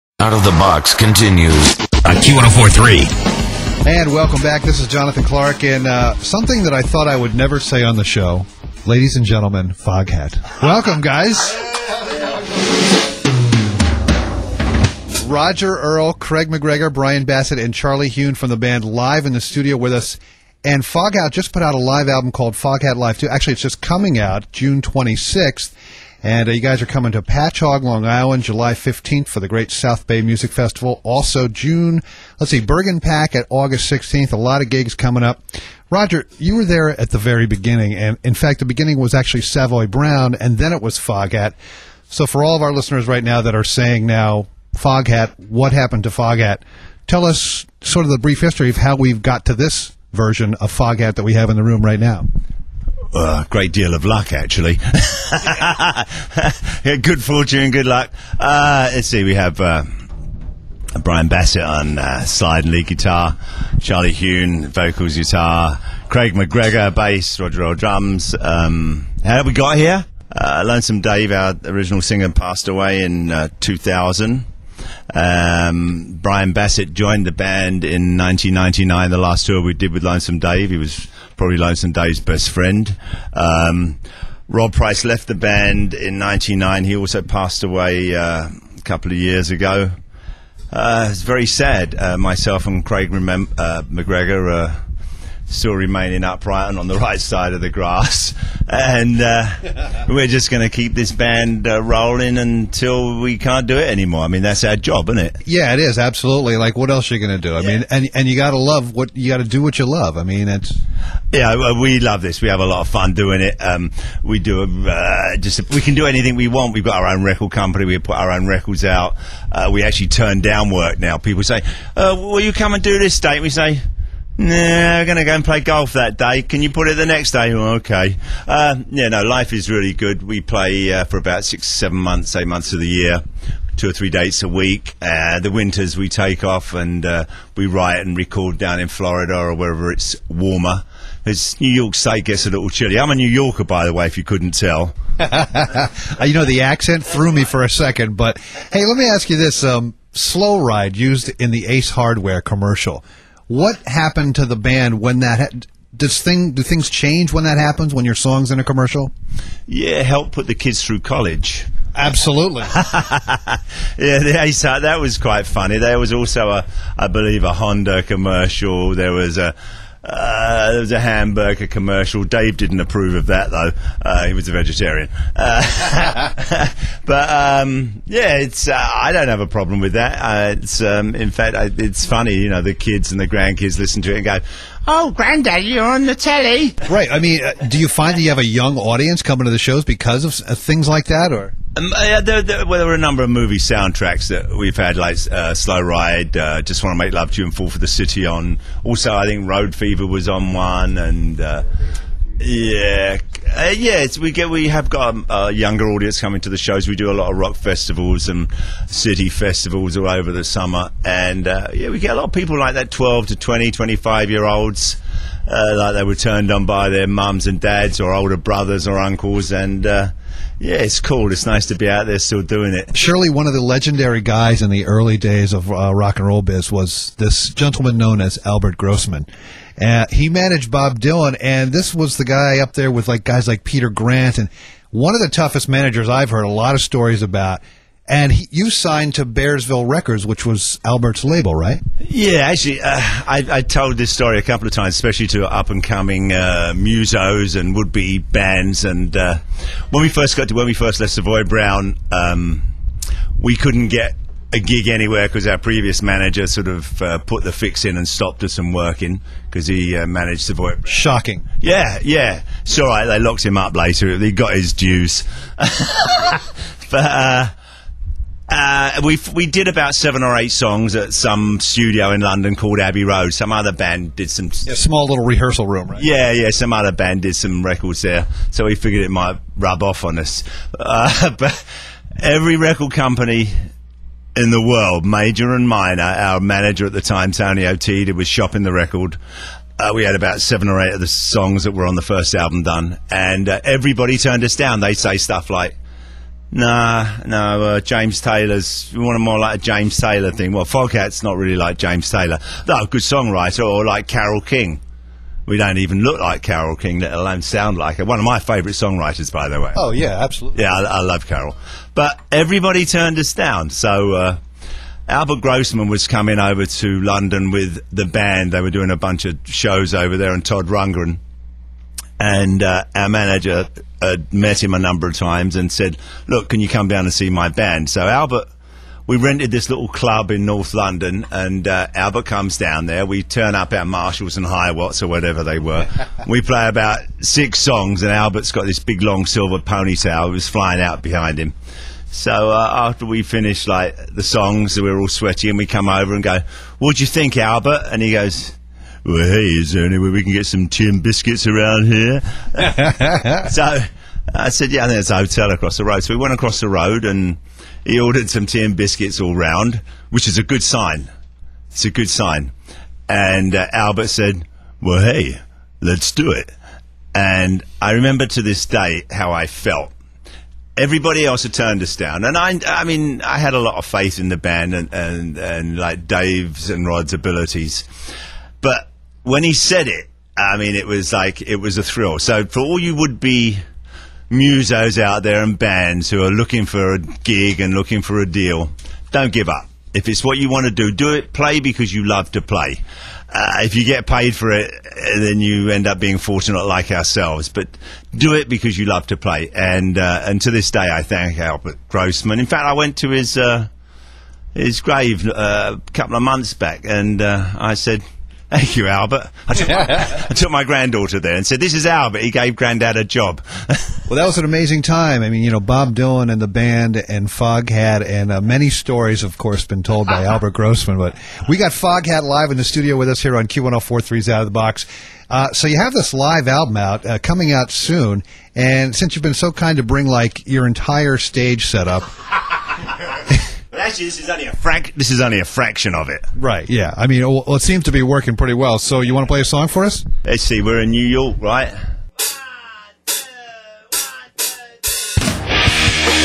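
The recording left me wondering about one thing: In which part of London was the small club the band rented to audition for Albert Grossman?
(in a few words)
North London.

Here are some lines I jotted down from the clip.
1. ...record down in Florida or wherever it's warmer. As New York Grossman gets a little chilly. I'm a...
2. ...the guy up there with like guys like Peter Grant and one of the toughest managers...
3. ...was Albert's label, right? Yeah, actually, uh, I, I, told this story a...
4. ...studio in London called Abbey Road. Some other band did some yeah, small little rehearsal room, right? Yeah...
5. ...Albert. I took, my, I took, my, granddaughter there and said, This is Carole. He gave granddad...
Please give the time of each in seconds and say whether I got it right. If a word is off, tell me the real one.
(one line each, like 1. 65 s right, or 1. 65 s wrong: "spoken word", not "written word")
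1. 138 s wrong: "State", not "Grossman"
2. 232 s right
3. 240 s right
4. 271 s right
5. 408 s wrong: "Albert", not "Carole".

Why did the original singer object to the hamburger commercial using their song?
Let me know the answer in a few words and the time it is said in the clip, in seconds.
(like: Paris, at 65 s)
He was a vegetarian, at 174 s.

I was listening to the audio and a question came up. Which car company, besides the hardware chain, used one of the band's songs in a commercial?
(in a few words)
Honda.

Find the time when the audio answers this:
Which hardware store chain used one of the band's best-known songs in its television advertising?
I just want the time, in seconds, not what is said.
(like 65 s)
151 s.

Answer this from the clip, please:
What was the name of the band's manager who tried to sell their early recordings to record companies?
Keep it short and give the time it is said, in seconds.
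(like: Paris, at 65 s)
Tony Outeda, at 287 s.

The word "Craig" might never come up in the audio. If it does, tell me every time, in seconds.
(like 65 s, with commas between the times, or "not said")
16 s, 66 s, 92 s.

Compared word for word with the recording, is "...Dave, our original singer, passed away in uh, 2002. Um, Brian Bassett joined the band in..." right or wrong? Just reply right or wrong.
wrong.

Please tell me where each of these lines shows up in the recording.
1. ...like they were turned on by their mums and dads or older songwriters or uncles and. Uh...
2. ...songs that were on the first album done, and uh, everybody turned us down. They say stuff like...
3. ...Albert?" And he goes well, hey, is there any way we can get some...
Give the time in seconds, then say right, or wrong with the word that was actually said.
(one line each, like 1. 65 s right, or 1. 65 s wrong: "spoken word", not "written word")
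1. 215 s wrong: "brothers", not "songwriters"
2. 291 s right
3. 347 s right.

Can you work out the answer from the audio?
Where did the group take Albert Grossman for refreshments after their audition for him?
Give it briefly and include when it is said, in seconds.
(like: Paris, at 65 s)
A hotel across the road, at 355 s.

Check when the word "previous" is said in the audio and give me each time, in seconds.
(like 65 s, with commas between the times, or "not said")
255 s.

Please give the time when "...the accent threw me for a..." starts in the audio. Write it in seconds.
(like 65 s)
146 s.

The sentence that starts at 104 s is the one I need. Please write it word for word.
I mean, that's our job, isn't it?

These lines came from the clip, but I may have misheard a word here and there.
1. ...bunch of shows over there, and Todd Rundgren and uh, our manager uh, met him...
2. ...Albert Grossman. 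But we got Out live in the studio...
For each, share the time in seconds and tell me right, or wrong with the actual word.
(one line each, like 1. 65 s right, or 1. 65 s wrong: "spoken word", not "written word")
1. 318 s right
2. 420 s wrong: "Foghat", not "Out".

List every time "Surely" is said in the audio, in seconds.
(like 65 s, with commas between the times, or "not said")
222 s.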